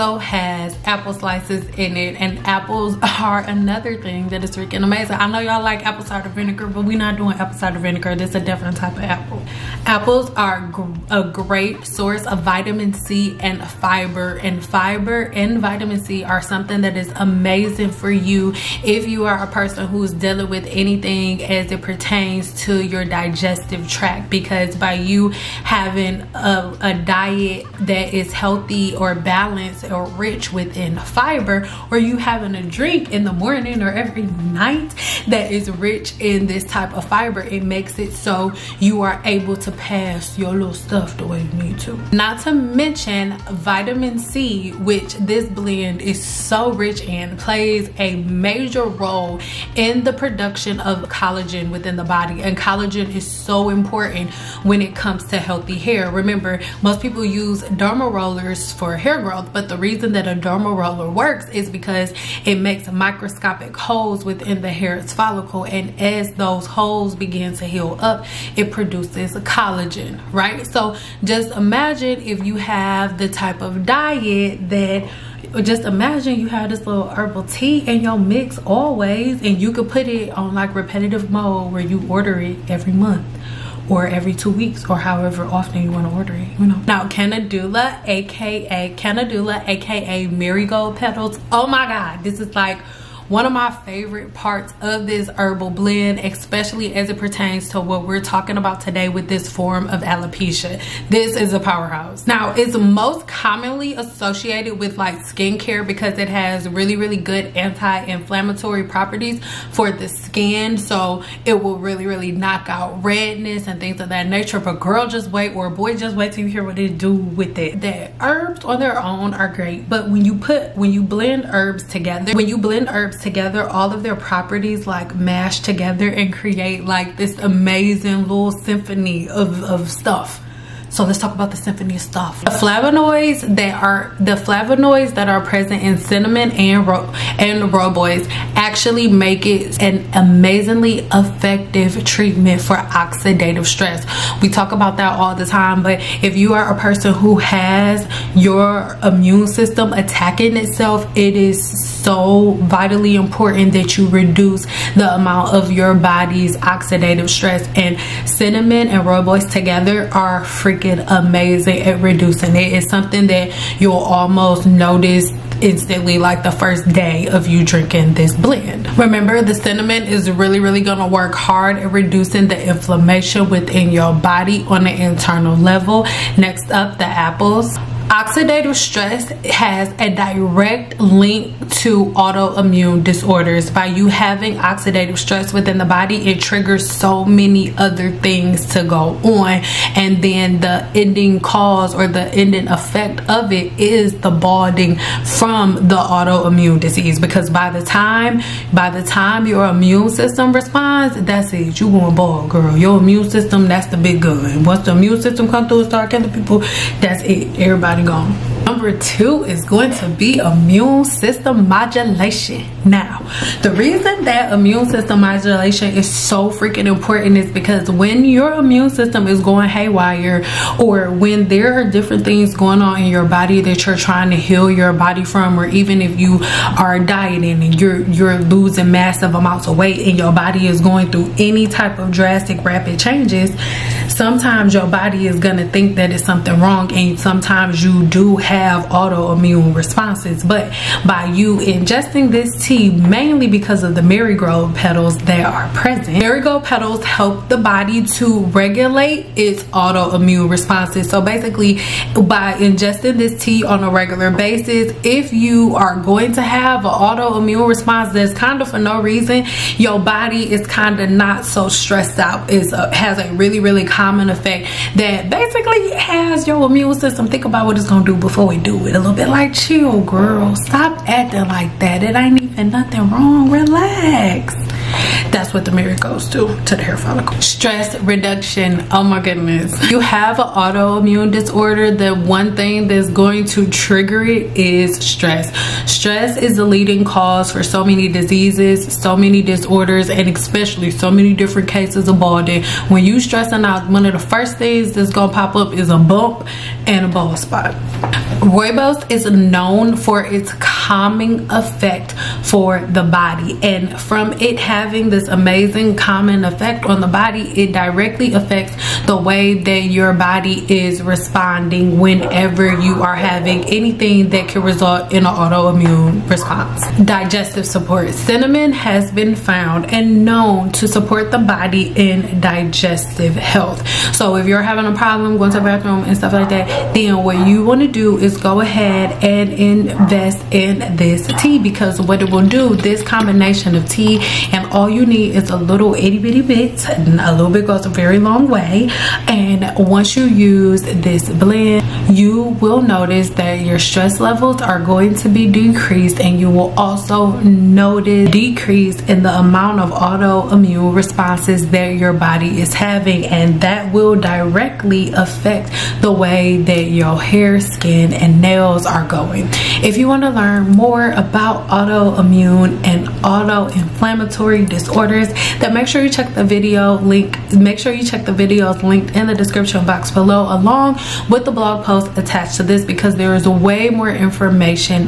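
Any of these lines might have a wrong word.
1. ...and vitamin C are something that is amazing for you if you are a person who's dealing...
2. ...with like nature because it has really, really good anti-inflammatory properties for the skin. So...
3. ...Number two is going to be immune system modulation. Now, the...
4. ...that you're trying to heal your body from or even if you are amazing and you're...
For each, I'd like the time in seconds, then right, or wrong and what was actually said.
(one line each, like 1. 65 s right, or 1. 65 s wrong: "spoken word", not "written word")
1. 15 s right
2. 104 s wrong: "skincare", not "nature"
3. 208 s right
4. 223 s wrong: "dieting", not "amazing".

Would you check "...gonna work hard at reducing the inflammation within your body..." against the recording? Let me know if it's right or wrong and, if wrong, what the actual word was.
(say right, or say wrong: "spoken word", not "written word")
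right.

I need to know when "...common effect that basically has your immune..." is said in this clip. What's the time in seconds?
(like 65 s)
263 s.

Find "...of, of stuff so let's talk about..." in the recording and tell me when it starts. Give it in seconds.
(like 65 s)
129 s.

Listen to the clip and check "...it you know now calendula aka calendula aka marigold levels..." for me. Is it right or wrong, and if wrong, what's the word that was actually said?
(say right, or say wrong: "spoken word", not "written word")
wrong: "petals", not "levels".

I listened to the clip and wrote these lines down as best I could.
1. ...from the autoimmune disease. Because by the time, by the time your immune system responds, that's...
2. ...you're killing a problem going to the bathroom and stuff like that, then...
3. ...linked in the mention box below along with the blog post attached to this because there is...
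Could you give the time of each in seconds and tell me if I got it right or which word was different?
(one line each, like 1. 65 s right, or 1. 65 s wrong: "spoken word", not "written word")
1. 195 s right
2. 324 s wrong: "having", not "killing"
3. 368 s wrong: "description", not "mention".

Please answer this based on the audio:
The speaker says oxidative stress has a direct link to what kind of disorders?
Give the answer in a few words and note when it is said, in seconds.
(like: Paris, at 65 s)
Autoimmune disorders, at 182 s.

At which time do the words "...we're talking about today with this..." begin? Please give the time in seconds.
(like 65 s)
98 s.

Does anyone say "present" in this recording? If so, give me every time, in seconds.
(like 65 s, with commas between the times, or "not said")
135 s, 245 s.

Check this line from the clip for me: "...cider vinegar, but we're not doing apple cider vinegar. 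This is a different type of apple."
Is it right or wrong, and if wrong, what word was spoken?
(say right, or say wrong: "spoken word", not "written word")
right.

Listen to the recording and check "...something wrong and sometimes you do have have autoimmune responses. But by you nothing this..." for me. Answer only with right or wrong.
wrong.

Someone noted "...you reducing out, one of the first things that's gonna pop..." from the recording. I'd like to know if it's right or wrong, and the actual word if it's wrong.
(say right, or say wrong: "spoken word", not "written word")
wrong: "stressing", not "reducing".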